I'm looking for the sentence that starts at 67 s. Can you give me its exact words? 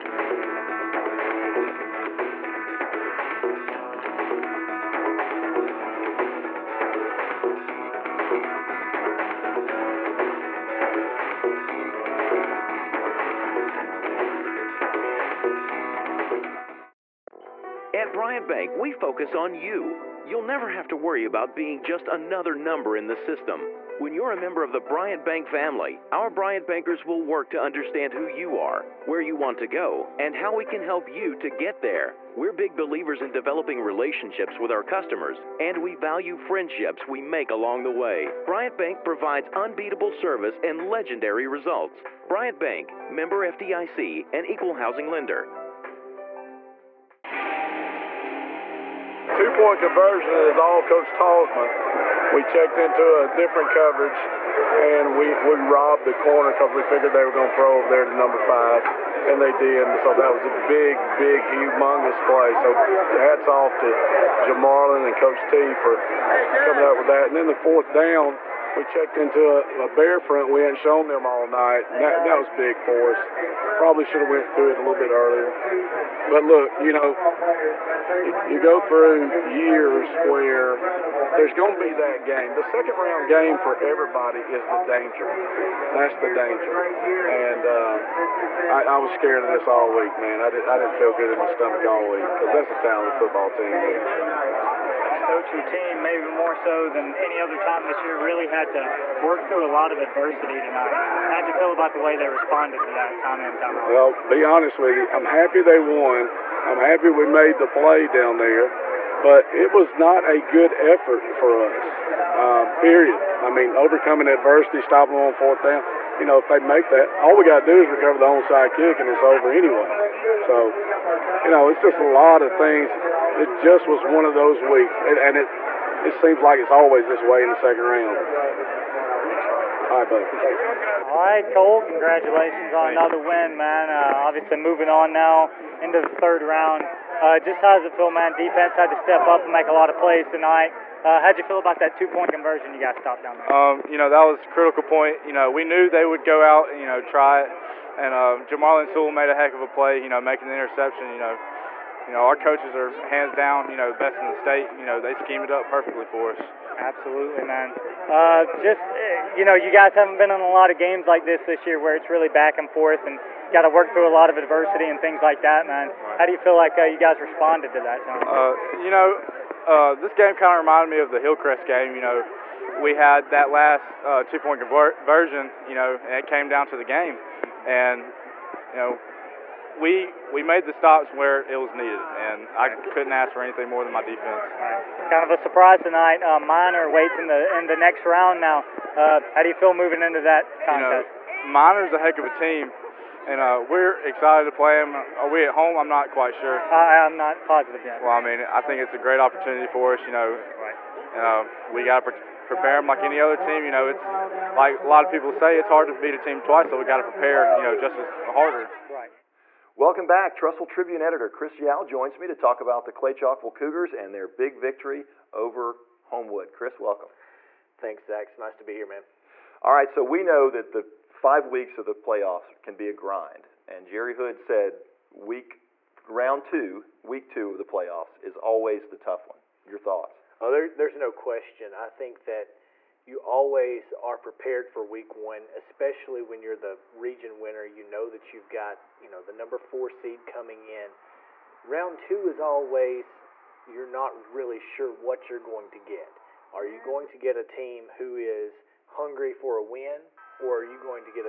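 And then the fourth down – we checked into a, a bear front we hadn't shown them all night.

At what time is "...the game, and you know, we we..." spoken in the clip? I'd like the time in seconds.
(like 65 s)
176 s.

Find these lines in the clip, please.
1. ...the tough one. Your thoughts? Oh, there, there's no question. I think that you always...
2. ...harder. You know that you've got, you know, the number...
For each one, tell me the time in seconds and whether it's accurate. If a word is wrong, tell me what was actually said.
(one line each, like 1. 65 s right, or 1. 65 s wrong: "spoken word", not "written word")
1. 228 s right
2. 237 s wrong: "winner", not "harder".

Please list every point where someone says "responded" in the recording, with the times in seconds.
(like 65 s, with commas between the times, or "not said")
102 s, 167 s.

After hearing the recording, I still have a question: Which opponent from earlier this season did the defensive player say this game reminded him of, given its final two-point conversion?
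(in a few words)
Hillcrest.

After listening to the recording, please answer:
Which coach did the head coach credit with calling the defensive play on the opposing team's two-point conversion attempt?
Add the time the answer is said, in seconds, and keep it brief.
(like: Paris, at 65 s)
Coach Talsman, at 50 s.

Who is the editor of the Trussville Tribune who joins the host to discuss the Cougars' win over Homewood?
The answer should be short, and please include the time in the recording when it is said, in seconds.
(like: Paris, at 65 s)
Chris Yao, at 211 s.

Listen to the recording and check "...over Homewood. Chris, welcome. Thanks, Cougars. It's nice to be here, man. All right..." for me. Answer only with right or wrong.
wrong.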